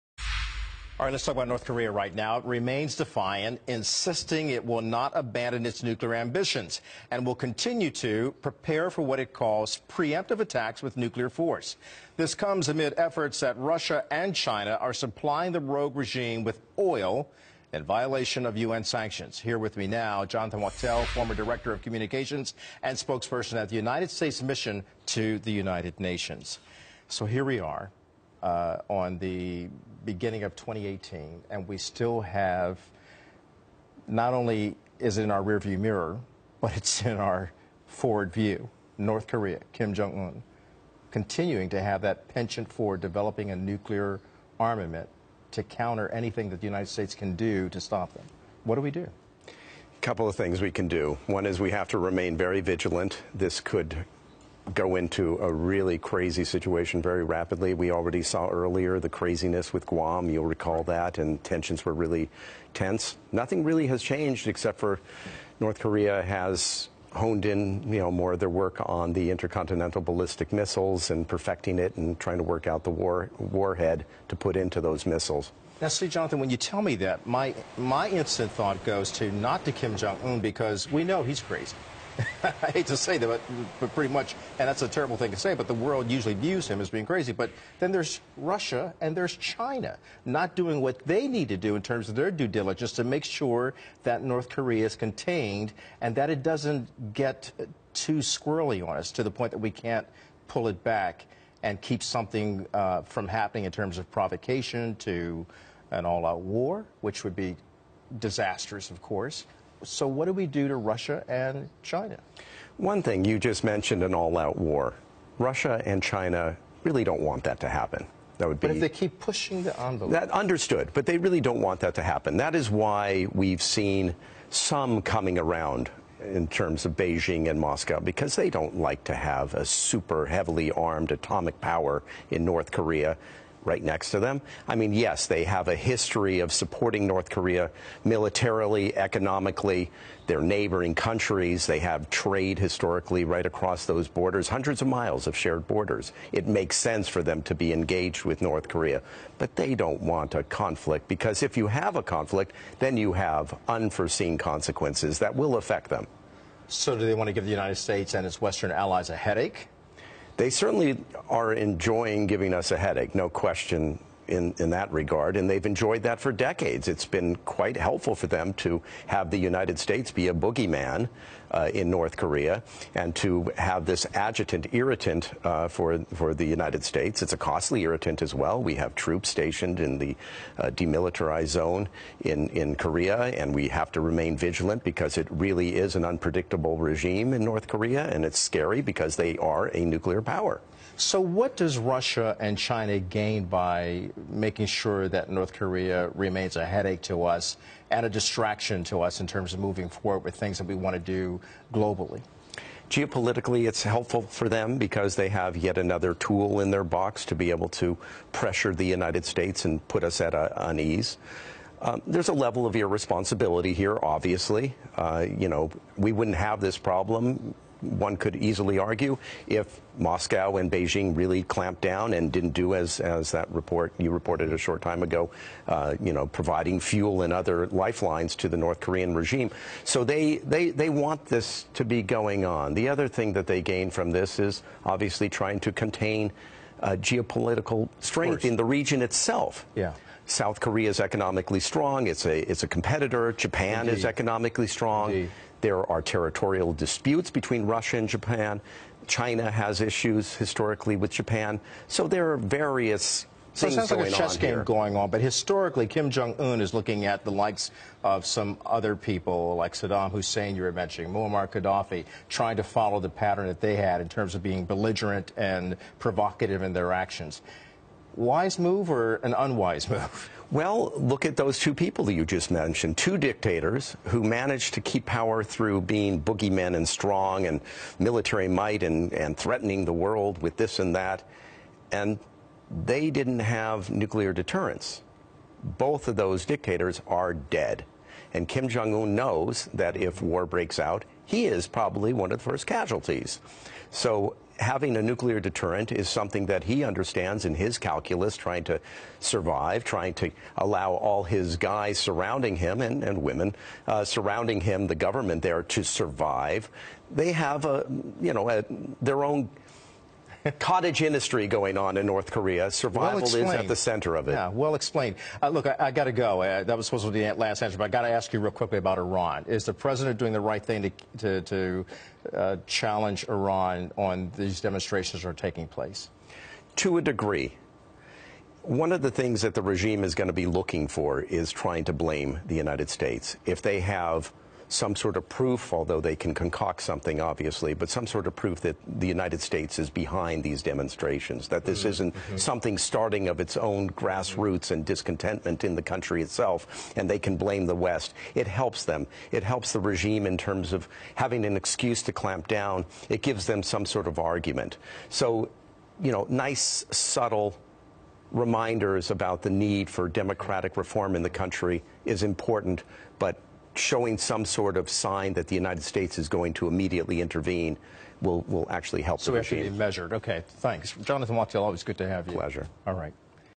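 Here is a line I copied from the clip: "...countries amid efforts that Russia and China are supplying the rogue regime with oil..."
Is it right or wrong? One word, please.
wrong.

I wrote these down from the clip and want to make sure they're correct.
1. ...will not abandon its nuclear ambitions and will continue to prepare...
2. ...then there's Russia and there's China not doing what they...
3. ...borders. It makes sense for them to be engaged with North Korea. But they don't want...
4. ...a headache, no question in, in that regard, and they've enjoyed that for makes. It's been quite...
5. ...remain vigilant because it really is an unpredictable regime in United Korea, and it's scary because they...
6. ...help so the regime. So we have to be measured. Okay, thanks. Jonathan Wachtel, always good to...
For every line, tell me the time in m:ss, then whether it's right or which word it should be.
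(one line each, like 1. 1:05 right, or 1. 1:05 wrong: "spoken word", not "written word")
1. 0:04 right
2. 1:27 right
3. 2:25 right
4. 2:42 wrong: "decades", not "makes"
5. 3:04 wrong: "North", not "United"
6. 6:09 right.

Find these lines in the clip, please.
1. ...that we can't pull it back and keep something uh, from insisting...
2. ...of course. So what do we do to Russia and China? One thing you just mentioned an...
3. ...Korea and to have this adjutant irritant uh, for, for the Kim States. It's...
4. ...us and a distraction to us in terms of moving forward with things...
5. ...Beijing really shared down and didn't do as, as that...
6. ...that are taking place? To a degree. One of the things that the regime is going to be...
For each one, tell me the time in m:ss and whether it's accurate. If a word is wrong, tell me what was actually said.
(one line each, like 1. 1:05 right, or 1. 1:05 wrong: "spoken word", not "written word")
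1. 1:39 wrong: "happening", not "insisting"
2. 1:48 right
3. 2:52 wrong: "United", not "Kim"
4. 3:17 right
5. 3:40 wrong: "clamped", not "shared"
6. 5:25 right.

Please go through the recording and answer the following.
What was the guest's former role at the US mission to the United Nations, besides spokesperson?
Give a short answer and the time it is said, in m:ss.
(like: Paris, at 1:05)
director of communications, at 0:21.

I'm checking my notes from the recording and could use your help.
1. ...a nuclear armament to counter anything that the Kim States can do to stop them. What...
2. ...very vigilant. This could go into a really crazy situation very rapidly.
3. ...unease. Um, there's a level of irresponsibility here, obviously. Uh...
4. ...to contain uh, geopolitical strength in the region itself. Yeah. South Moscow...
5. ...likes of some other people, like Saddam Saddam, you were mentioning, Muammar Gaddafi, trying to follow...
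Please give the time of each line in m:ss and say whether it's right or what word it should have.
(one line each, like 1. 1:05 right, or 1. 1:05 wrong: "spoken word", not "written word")
1. 0:43 wrong: "United", not "Kim"
2. 0:52 right
3. 3:30 right
4. 3:55 wrong: "Korea", not "Moscow"
5. 4:17 wrong: "Hussein", not "Saddam".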